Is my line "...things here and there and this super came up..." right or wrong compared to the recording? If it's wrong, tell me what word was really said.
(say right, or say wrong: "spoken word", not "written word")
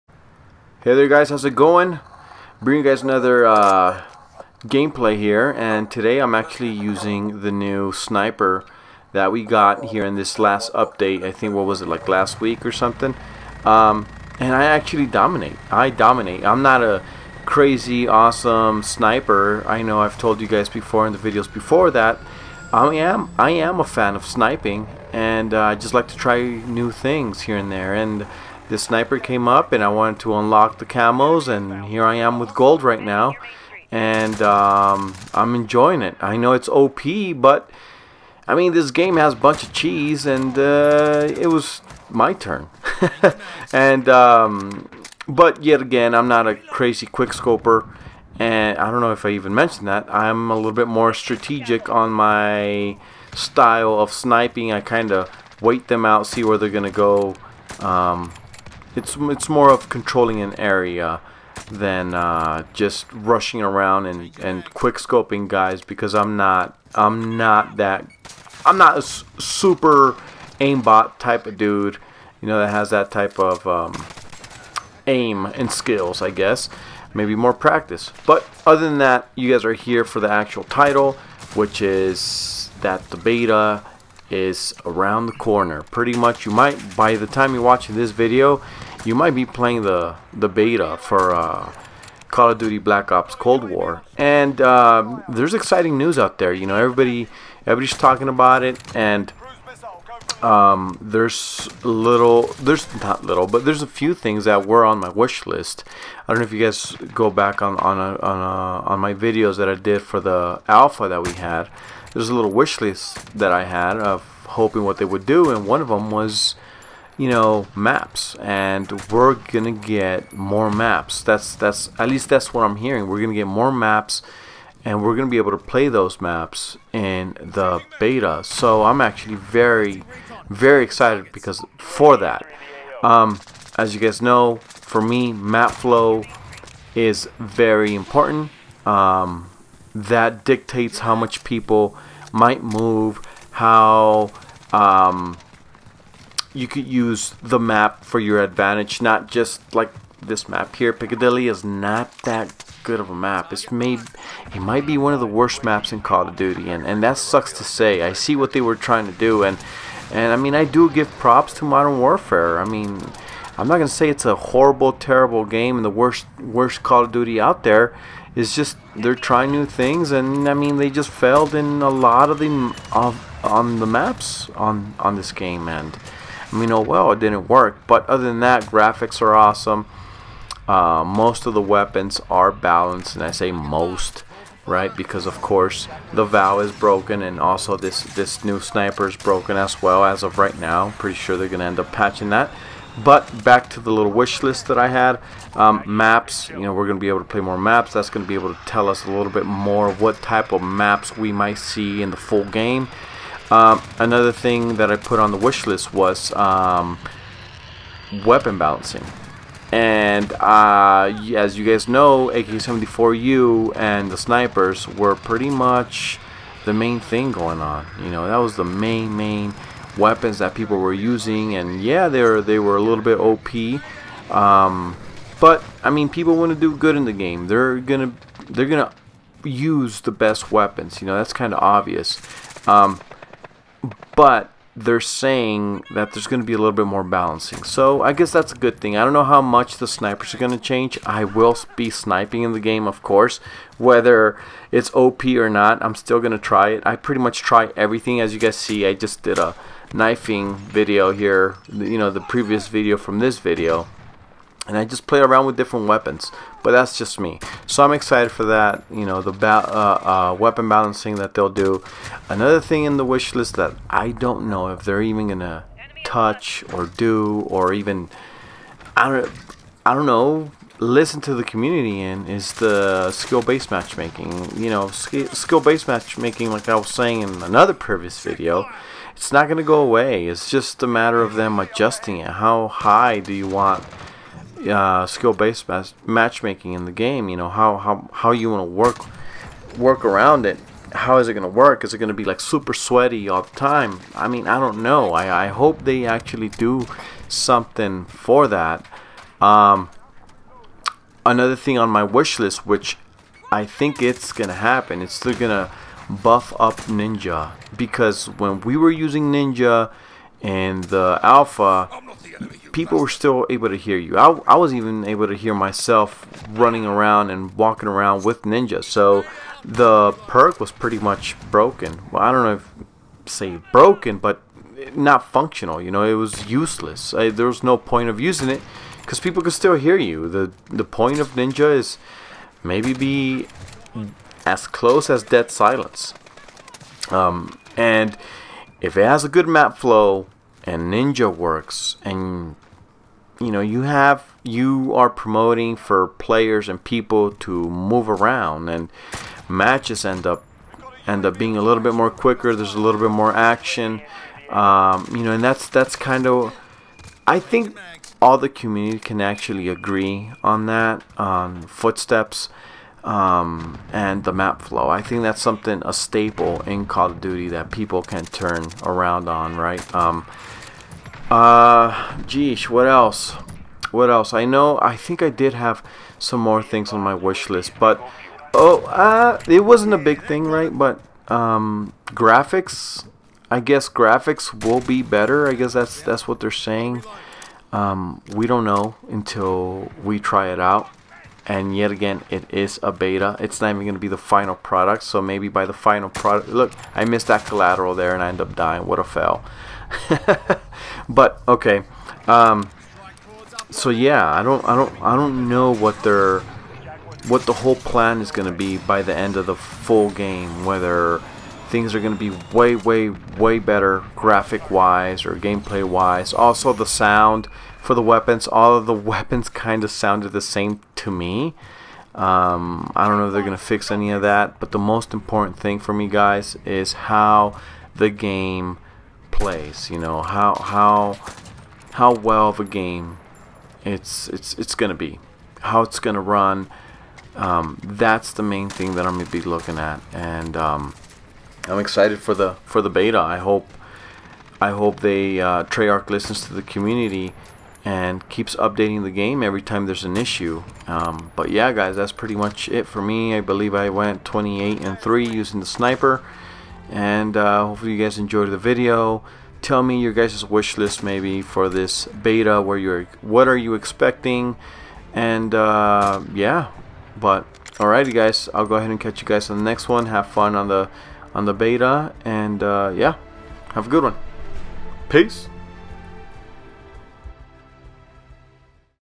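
wrong: "sniper", not "super".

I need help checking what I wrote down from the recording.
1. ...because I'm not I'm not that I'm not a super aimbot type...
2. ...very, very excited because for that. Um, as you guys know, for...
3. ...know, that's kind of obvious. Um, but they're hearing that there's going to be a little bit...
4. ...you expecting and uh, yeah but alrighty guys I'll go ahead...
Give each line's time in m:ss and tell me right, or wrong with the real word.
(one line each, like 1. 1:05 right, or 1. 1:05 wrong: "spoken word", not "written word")
1. 1:05 right
2. 2:09 right
3. 3:51 wrong: "saying", not "hearing"
4. 7:43 right.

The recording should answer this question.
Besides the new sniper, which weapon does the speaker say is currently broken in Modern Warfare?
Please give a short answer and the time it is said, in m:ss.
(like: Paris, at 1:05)
Vow, at 3:06.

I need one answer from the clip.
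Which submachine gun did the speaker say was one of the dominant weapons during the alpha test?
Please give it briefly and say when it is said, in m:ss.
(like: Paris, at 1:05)
AK-74U, at 3:32.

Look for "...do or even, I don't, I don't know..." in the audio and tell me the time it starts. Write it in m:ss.
4:26.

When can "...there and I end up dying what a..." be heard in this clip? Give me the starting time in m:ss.
6:37.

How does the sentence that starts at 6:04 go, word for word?
I think that's something a staple in Call of Duty that people can turn around on, right?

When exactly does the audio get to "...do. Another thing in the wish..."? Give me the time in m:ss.
4:21.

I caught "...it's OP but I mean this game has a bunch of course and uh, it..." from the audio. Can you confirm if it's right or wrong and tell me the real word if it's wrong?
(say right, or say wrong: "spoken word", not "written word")
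wrong: "cheese", not "course".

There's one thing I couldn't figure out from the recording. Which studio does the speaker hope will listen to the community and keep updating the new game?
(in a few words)
Treyarch.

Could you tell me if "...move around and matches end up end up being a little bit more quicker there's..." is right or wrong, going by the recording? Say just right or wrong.
right.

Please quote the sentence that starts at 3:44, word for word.
Um, but I mean, people want to do good in the game.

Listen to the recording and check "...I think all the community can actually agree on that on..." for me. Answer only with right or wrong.
right.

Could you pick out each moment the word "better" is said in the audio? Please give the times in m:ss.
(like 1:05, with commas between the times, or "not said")
6:25, 6:53.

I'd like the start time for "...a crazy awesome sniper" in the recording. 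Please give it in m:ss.
0:16.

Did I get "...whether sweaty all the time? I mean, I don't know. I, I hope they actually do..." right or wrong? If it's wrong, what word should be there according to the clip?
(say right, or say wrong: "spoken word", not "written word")
wrong: "super", not "whether".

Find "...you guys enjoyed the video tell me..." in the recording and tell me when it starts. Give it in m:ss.
7:37.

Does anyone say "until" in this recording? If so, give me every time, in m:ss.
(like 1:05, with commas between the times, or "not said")
6:29.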